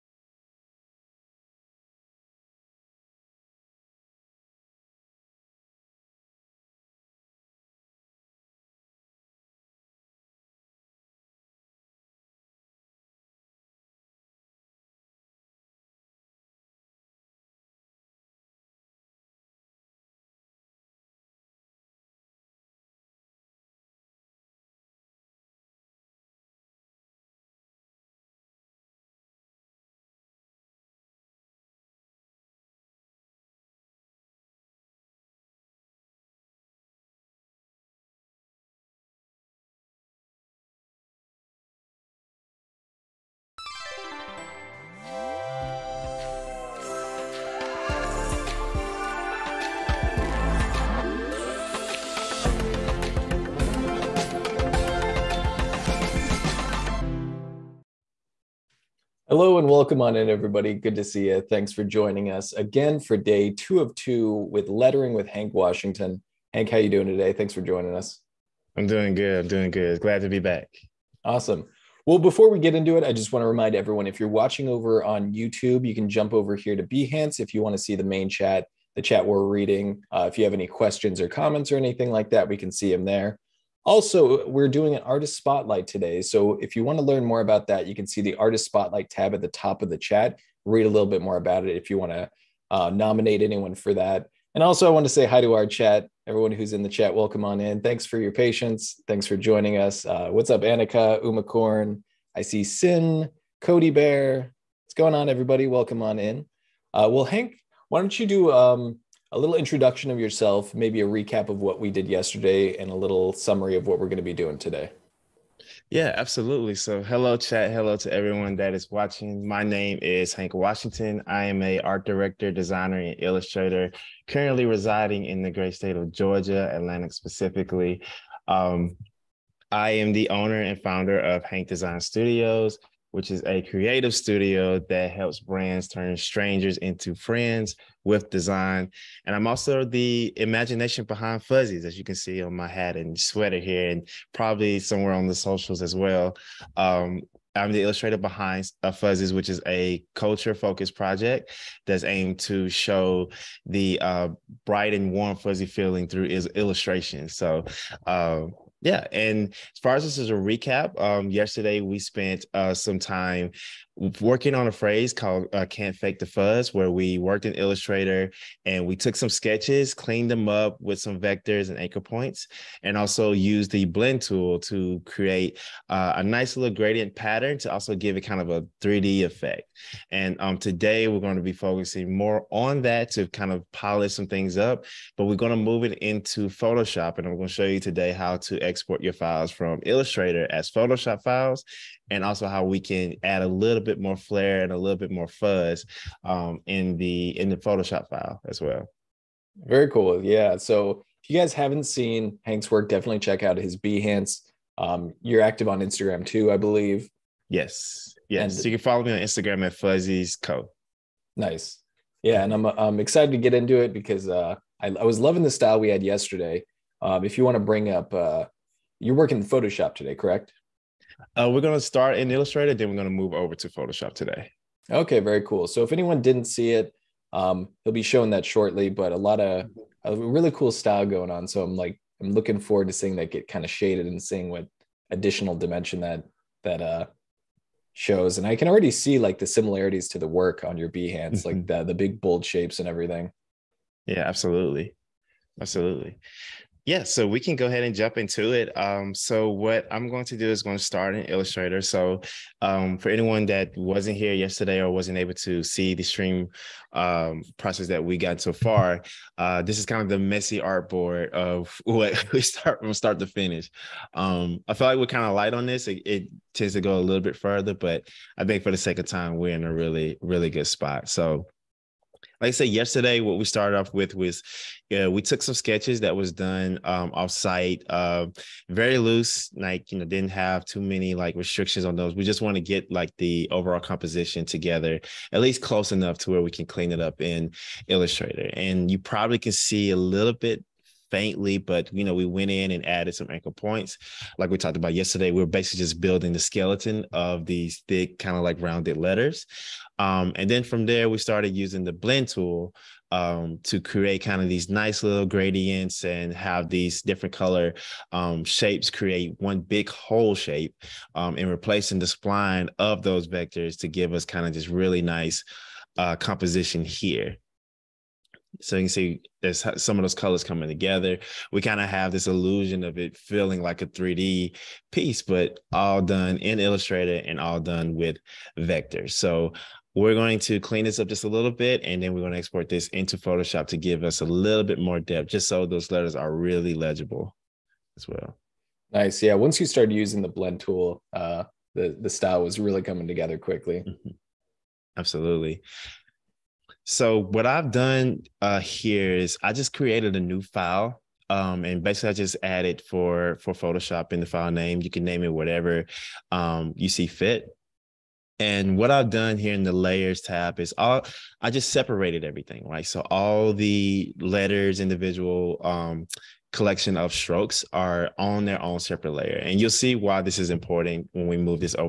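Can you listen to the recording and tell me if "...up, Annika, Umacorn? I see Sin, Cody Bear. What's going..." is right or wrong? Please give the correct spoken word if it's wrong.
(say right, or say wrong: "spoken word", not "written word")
right.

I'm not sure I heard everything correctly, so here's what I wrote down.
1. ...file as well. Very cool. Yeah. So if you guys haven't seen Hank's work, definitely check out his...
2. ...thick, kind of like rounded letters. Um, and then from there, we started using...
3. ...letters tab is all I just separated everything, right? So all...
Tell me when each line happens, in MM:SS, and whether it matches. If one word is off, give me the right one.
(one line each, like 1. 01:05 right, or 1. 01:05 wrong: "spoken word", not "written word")
1. 03:18 right
2. 04:57 right
3. 05:59 wrong: "layers", not "letters".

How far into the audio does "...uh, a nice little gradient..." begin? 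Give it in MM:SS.
02:55.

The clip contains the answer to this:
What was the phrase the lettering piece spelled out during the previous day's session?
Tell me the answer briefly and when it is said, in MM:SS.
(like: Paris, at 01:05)
Can't fake the fuzz, at 02:45.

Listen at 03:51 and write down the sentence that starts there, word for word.
So I'm like, I'm looking forward to seeing that get kind of shaded and seeing what additional dimension that that uh shows.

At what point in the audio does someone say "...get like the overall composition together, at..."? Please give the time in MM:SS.
04:42.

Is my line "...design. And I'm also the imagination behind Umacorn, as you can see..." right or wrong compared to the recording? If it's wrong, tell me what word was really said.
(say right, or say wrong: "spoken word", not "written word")
wrong: "Fuzzies", not "Umacorn".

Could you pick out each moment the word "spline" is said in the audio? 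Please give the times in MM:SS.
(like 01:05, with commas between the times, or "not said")
05:12.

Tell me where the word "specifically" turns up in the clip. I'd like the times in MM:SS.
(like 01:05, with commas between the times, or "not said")
02:07.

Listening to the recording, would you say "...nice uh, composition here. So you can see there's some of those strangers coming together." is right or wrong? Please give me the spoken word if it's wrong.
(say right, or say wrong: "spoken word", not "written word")
wrong: "colors", not "strangers".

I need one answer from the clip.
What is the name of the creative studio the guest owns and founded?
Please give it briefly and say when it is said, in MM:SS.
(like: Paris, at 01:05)
Hank Design Studios, at 02:11.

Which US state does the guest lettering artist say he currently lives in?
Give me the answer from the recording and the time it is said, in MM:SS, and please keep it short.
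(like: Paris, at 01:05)
Georgia, at 02:06.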